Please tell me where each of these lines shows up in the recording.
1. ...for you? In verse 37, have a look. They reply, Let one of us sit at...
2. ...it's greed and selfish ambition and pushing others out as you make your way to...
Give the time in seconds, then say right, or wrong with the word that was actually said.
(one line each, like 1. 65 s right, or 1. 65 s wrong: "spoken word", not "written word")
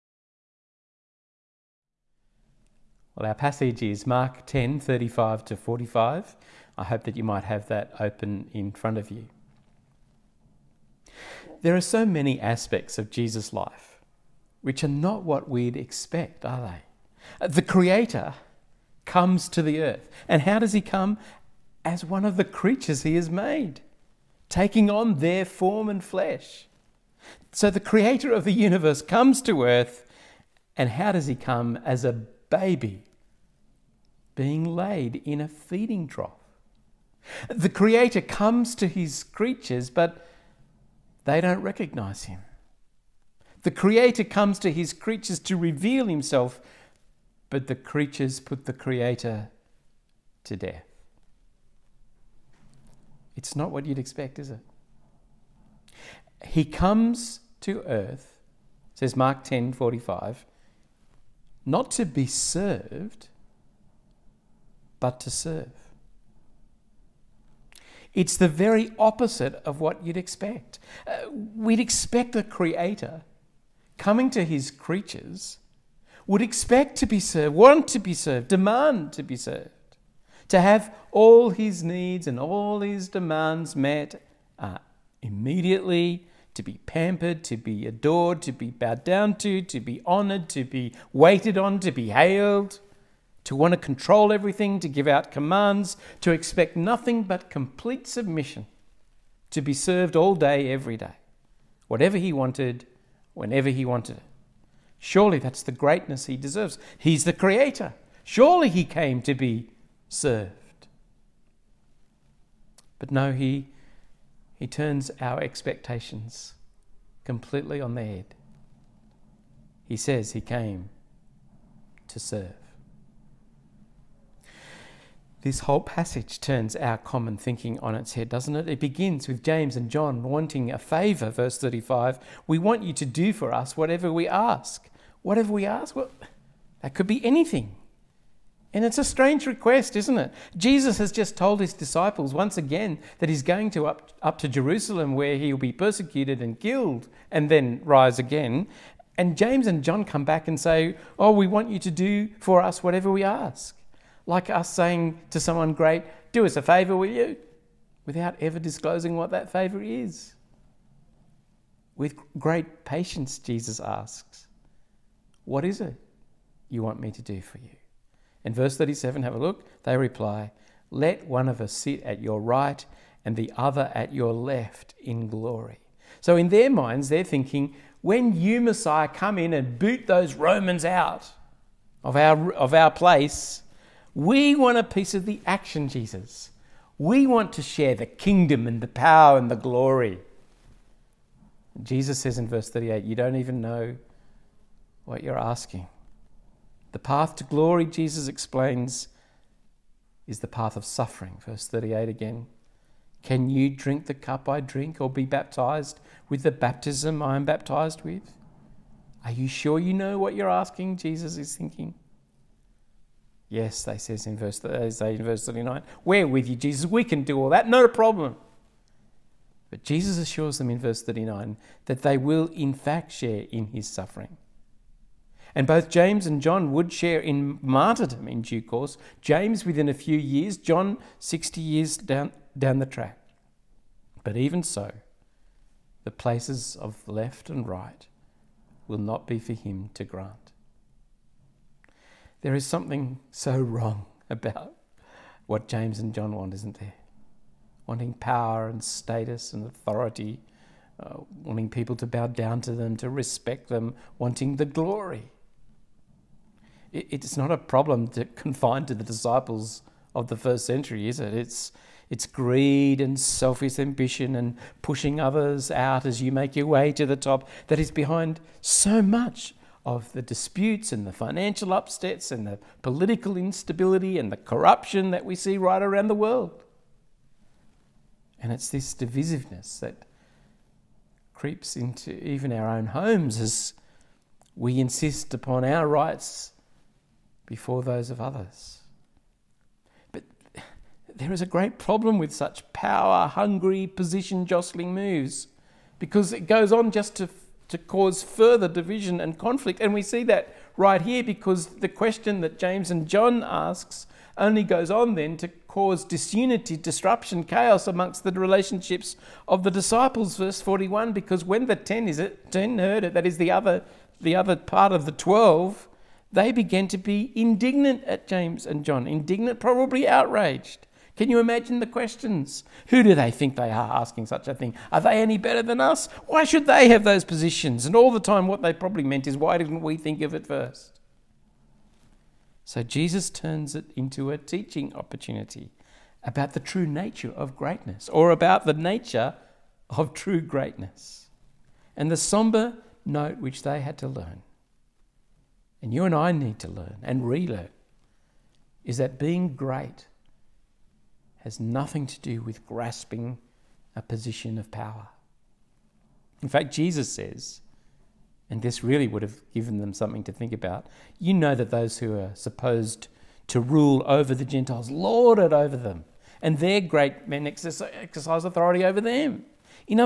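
1. 167 s right
2. 262 s right.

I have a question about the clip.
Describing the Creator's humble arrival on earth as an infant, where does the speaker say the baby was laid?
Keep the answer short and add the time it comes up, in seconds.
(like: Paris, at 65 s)
A feeding trough, at 35 s.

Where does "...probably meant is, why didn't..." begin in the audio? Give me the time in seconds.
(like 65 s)
328 s.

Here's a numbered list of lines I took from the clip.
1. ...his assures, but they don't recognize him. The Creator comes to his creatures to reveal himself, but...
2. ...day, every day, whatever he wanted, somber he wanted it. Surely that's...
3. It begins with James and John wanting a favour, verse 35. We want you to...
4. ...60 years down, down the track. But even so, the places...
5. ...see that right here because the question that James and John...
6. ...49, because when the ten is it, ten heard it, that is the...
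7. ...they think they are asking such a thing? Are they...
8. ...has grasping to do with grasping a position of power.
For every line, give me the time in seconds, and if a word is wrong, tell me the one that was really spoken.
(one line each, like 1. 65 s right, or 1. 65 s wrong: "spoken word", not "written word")
1. 38 s wrong: "creatures", not "assures"
2. 100 s wrong: "whenever", not "somber"
3. 128 s right
4. 231 s right
5. 300 s right
6. 310 s wrong: "41", not "49"
7. 323 s right
8. 351 s wrong: "nothing", not "grasping".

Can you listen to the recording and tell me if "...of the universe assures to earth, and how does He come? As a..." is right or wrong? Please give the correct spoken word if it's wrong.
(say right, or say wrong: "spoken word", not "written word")
wrong: "comes", not "assures".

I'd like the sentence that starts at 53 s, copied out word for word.
It's not what you'd expect, is it?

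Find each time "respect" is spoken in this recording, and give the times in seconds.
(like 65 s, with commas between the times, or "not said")
253 s.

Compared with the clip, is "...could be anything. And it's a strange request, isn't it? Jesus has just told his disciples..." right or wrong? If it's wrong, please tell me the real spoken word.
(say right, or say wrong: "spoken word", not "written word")
right.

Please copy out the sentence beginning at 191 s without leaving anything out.
Jesus says in verse 38, You don't even know what you're asking.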